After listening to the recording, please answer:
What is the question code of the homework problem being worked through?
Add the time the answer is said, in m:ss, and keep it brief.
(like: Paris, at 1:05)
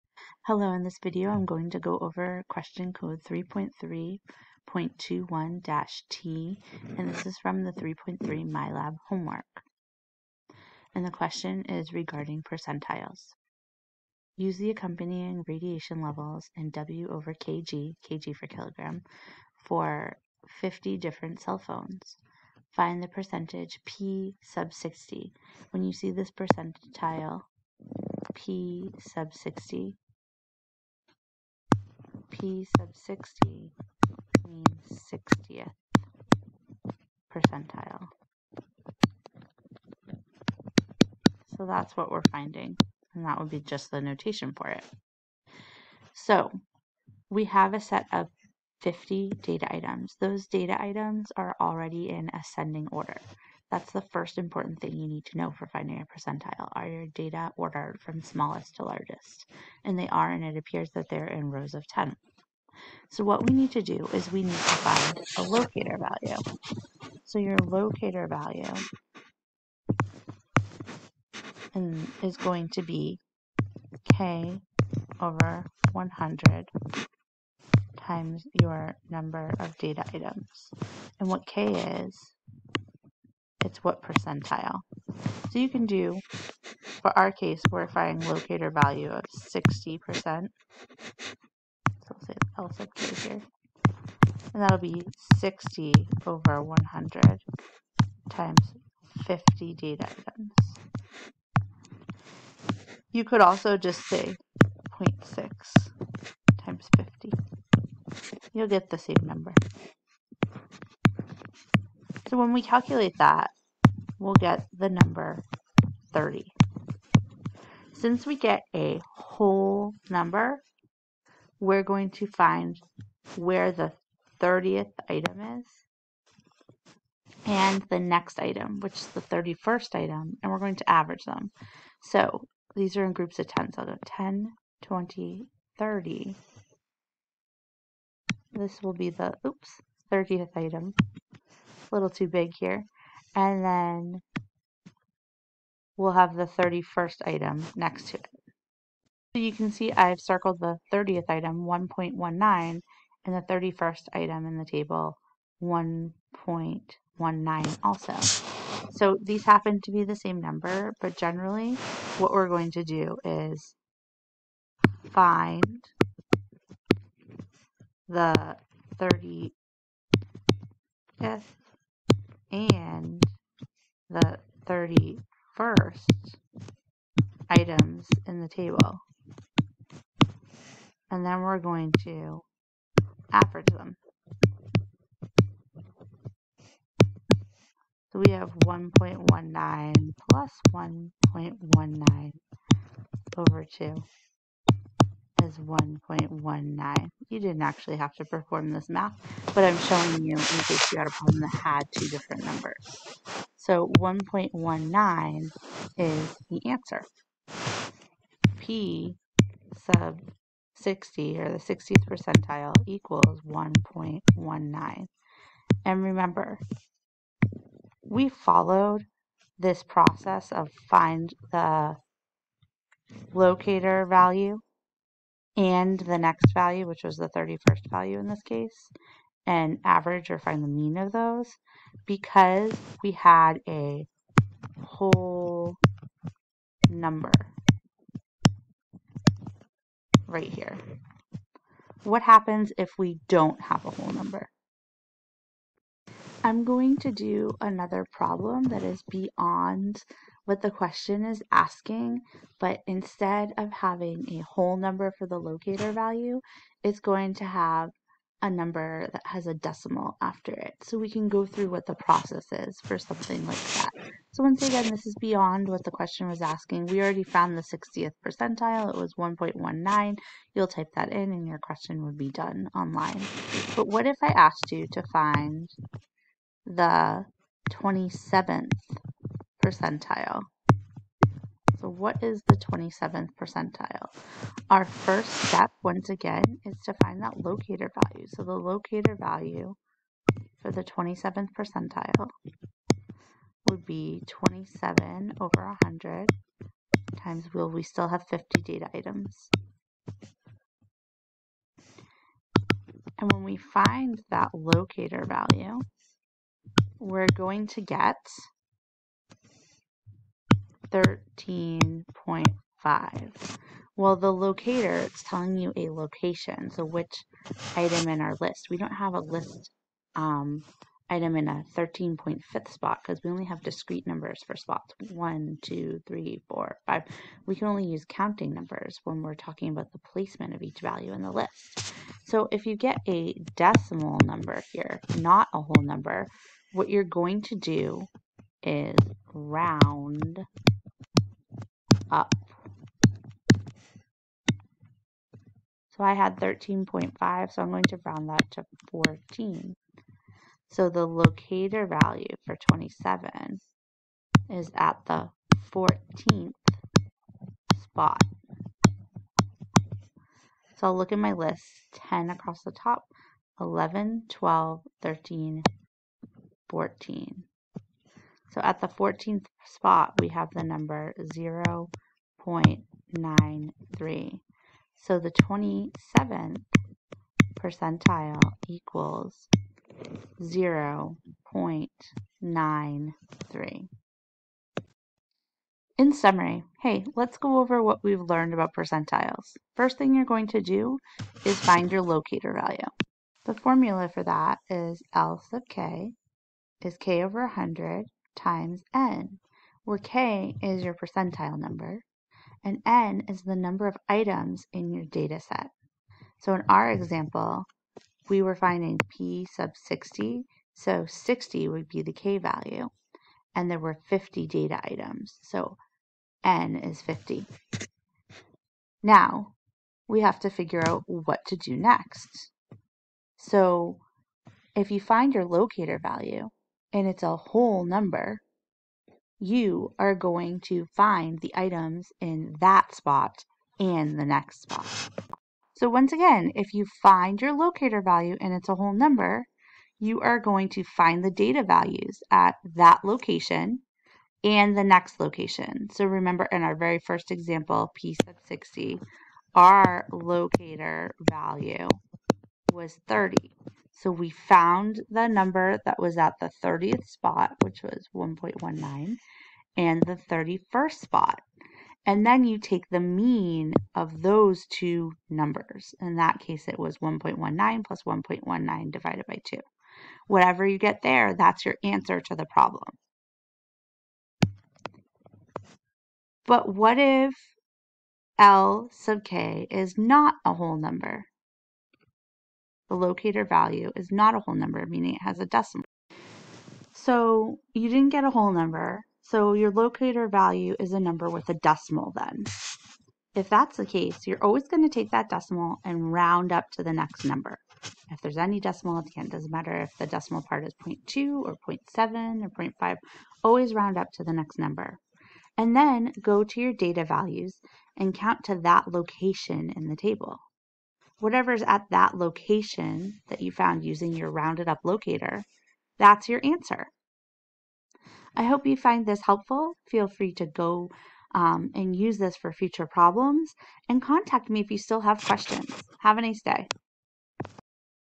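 3.3.21-T, at 0:03.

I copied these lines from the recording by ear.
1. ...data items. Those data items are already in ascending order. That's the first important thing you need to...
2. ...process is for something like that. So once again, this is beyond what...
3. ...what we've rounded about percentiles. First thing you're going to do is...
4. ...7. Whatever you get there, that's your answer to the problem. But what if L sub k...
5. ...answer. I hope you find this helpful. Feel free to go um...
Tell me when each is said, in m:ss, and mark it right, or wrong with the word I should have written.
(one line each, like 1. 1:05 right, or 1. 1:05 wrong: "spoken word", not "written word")
1. 0:49 right
2. 4:21 right
3. 6:27 wrong: "learned", not "rounded"
4. 7:49 wrong: "2", not "7"
5. 8:36 right.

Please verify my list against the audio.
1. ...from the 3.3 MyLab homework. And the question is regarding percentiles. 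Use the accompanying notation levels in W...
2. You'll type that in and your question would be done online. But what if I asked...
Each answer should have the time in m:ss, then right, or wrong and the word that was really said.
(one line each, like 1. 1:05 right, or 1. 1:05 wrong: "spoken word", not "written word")
1. 0:07 wrong: "radiation", not "notation"
2. 4:30 right.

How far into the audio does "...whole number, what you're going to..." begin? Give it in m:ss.
5:35.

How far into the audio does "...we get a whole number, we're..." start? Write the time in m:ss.
1:58.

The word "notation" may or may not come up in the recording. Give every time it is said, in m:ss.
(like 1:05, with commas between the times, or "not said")
0:44.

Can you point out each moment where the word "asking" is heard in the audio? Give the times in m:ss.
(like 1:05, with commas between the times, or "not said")
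4:11, 4:26.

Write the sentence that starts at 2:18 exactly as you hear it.
This will be the, oops, 30th item a little too big here.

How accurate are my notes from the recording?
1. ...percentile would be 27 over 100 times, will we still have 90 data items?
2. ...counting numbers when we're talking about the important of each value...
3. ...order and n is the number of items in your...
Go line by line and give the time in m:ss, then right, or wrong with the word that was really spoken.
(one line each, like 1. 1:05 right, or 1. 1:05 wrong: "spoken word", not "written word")
1. 4:51 wrong: "50", not "90"
2. 5:28 wrong: "placement", not "important"
3. 6:41 wrong: "number", not "order".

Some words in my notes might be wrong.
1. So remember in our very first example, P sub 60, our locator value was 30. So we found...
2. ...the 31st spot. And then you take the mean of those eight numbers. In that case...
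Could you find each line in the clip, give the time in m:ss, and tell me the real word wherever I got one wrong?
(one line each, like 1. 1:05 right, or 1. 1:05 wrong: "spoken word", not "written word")
1. 7:25 right
2. 7:40 wrong: "two", not "eight".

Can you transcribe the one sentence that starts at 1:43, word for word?
You could also just say 0.6 times 50.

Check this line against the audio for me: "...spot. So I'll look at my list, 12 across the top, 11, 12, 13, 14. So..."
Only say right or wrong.
wrong.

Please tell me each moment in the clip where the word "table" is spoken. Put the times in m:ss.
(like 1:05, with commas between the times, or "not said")
2:34, 2:58, 8:29.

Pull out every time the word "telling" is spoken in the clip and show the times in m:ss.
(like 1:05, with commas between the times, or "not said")
5:15.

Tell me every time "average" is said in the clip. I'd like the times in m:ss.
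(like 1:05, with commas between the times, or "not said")
2:10, 3:03, 3:49.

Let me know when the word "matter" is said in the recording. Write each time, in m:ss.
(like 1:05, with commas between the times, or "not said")
8:19.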